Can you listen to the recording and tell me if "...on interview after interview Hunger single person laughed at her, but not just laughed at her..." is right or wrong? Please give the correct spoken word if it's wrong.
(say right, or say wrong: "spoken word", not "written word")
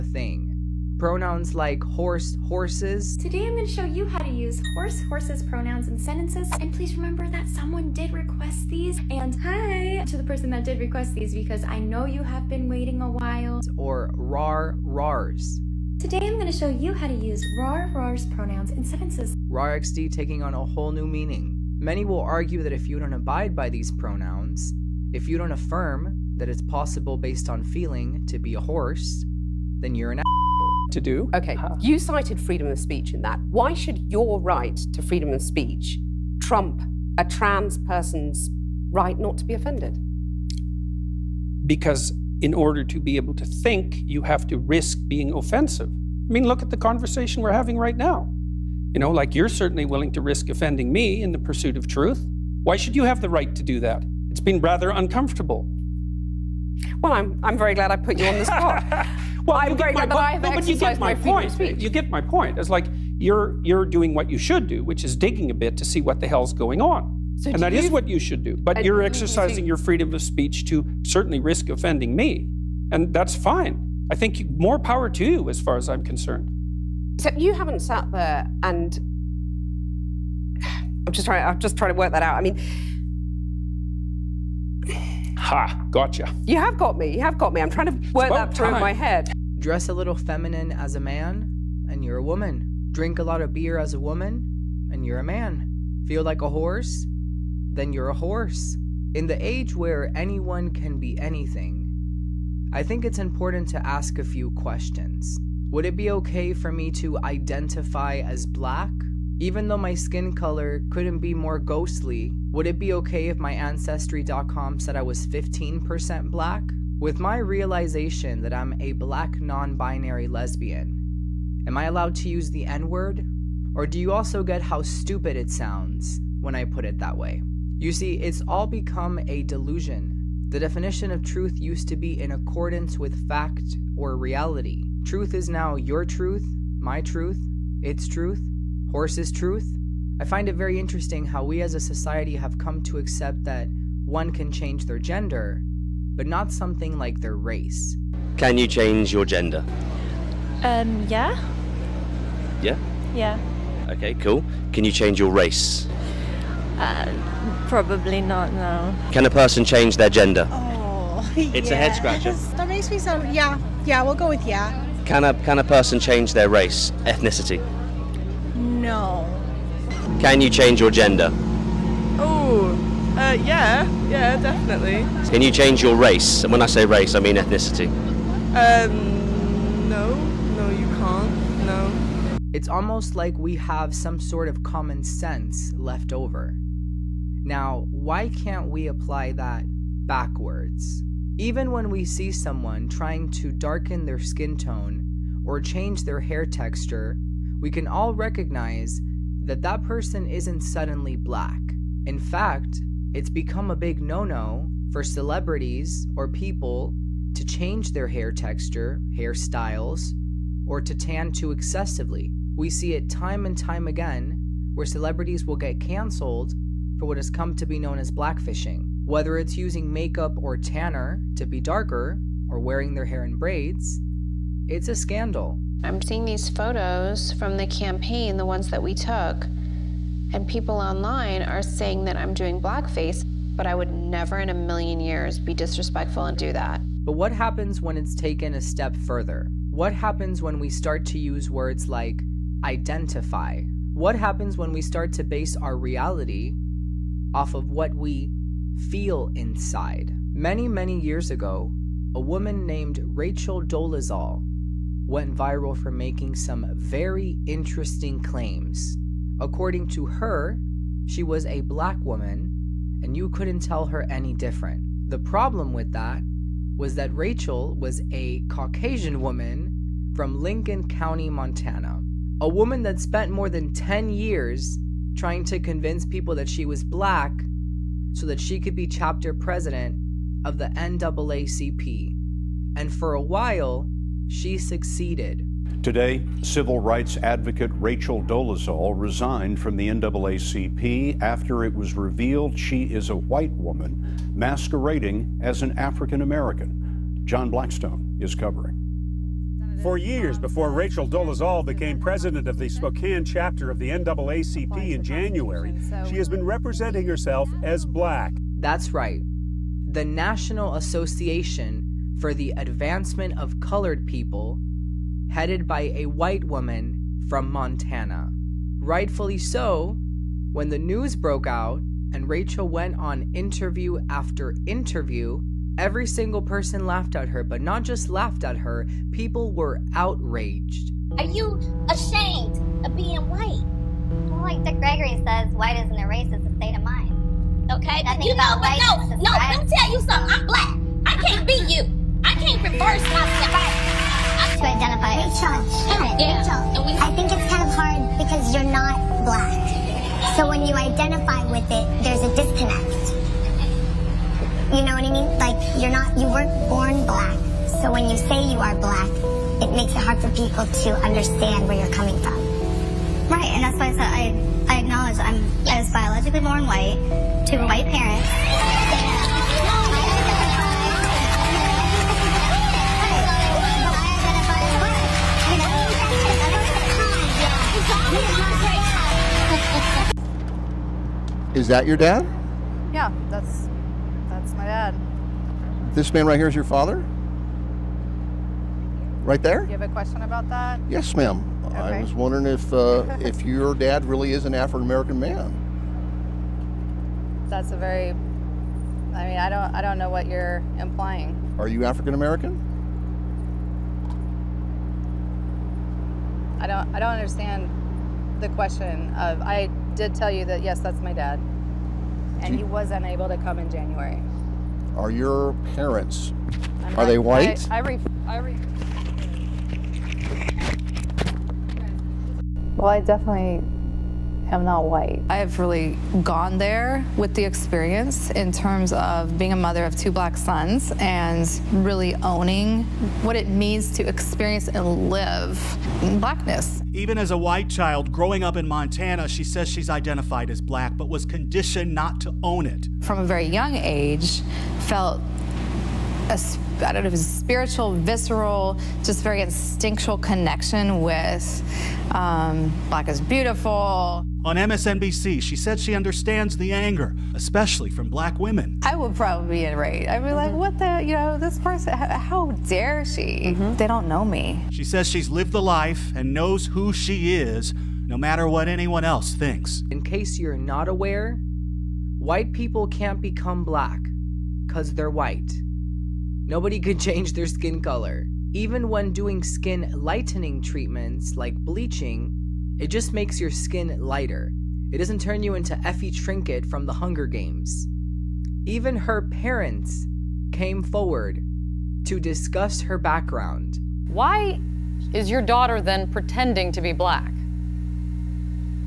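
wrong: "Every", not "Hunger".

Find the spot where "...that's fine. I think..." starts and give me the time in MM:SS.
01:13.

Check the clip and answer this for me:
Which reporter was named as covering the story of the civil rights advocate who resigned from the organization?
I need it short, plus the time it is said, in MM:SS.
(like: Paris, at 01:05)
John Blackstone, at 04:57.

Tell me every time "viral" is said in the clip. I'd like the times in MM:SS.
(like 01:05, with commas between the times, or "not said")
04:15.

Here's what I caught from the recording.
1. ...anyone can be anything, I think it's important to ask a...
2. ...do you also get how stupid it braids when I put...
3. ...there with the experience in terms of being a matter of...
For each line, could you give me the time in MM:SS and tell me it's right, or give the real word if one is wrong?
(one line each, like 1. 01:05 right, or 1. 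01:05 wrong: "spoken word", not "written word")
1. 01:40 right
2. 02:03 wrong: "sounds", not "braids"
3. 07:06 wrong: "mother", not "matter".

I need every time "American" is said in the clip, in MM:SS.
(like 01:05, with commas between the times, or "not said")
04:56, 06:34, 06:42.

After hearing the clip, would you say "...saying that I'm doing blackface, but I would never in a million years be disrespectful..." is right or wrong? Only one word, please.
right.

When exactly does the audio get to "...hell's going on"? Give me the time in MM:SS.
01:06.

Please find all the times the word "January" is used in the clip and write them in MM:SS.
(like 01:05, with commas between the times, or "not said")
05:05, 06:53.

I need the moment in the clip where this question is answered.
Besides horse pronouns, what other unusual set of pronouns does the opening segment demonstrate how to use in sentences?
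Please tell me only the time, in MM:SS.
00:14.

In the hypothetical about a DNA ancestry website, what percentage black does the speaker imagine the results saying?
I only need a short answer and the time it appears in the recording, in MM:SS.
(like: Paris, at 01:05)
15%, at 01:55.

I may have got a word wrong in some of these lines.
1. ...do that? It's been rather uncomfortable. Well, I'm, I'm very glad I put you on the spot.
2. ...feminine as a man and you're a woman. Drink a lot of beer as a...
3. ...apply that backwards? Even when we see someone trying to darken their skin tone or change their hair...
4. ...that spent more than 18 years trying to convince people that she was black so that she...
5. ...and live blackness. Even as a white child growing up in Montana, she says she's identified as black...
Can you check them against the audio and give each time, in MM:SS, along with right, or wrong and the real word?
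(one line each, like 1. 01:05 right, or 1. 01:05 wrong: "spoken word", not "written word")
1. 00:53 right
2. 01:30 right
3. 03:08 right
4. 04:32 wrong: "10", not "18"
5. 07:14 right.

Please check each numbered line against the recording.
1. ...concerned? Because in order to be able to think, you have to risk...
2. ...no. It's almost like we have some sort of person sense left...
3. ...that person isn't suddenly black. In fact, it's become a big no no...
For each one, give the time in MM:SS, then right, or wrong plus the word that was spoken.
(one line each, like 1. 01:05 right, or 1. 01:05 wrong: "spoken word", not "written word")
1. 00:39 wrong: "offended", not "concerned"
2. 03:01 wrong: "common", not "person"
3. 03:19 right.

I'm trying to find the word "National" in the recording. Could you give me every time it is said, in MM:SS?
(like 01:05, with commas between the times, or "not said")
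05:10.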